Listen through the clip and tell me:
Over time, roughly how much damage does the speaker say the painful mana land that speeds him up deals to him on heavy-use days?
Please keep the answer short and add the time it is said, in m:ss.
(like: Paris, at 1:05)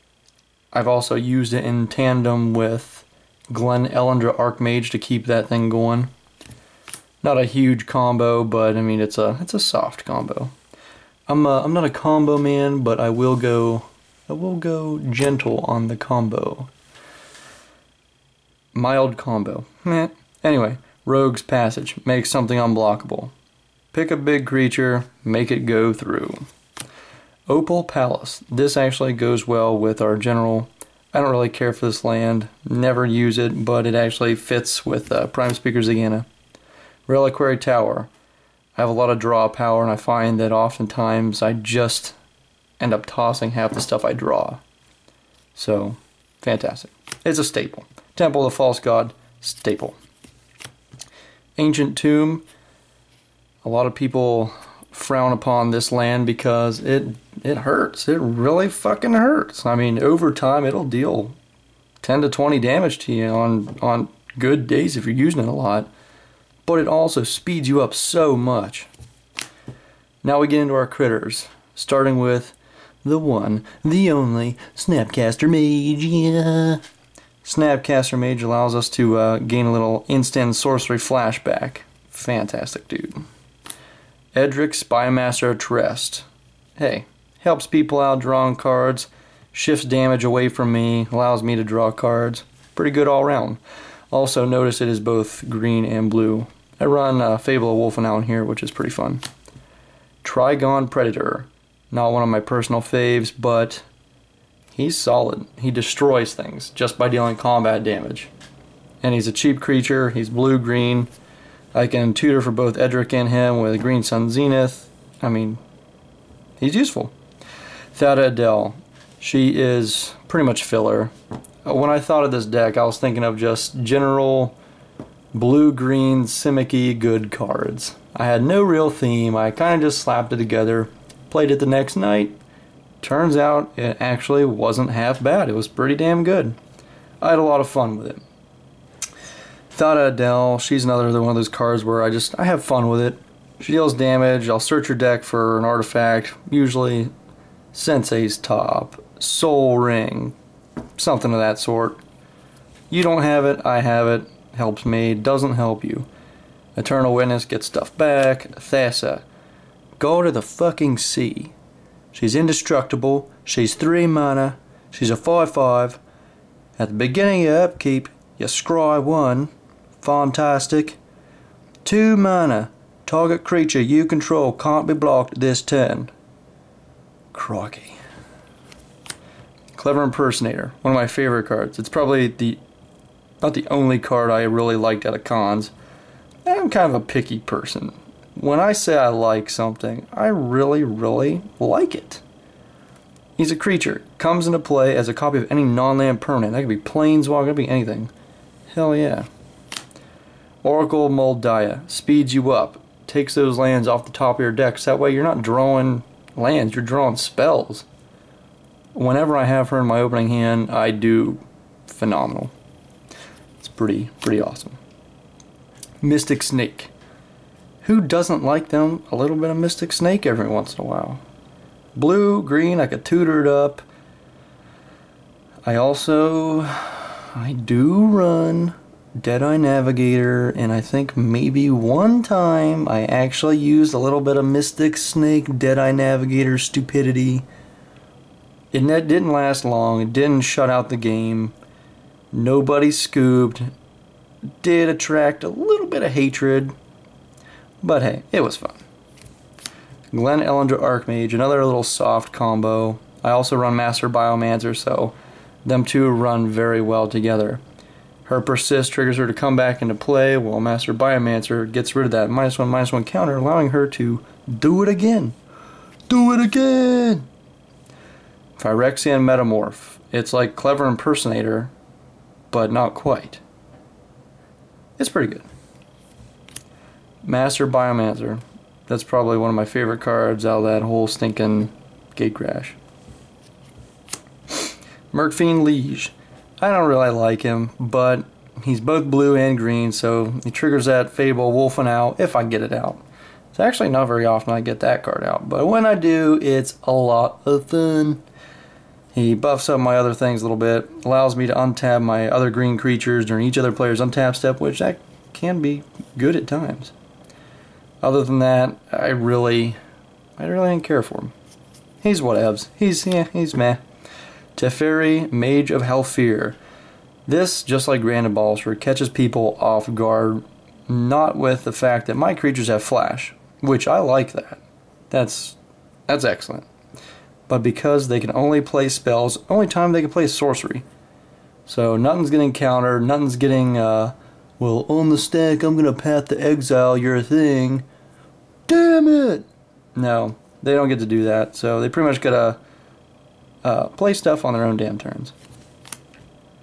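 10 to 20, at 1:02.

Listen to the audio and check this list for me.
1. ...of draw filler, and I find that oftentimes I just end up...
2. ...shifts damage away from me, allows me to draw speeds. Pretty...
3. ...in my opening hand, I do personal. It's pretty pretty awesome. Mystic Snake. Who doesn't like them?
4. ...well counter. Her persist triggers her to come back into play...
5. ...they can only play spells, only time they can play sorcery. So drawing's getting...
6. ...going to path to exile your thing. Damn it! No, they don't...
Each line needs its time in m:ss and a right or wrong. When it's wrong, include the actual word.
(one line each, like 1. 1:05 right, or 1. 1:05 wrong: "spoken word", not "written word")
1. 0:39 wrong: "power", not "filler"
2. 1:29 wrong: "cards", not "speeds"
3. 3:29 wrong: "phenomenal", not "personal"
4. 4:16 wrong: "together", not "counter"
5. 5:28 wrong: "nothing", not "drawing"
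6. 5:35 right.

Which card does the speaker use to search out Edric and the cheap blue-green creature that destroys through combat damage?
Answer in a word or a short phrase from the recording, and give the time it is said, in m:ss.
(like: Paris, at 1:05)
Green Sun Zenith, at 1:53.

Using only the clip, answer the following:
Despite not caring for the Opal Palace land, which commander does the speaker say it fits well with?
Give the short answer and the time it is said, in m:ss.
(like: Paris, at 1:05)
Prime Speaker Zegana, at 0:35.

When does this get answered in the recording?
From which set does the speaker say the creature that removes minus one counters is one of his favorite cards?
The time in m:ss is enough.
4:42.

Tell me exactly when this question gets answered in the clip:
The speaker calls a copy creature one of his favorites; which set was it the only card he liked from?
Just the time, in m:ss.
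3:05.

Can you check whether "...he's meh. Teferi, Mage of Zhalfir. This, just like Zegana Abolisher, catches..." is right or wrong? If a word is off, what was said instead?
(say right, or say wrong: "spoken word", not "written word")
wrong: "Grand", not "Zegana".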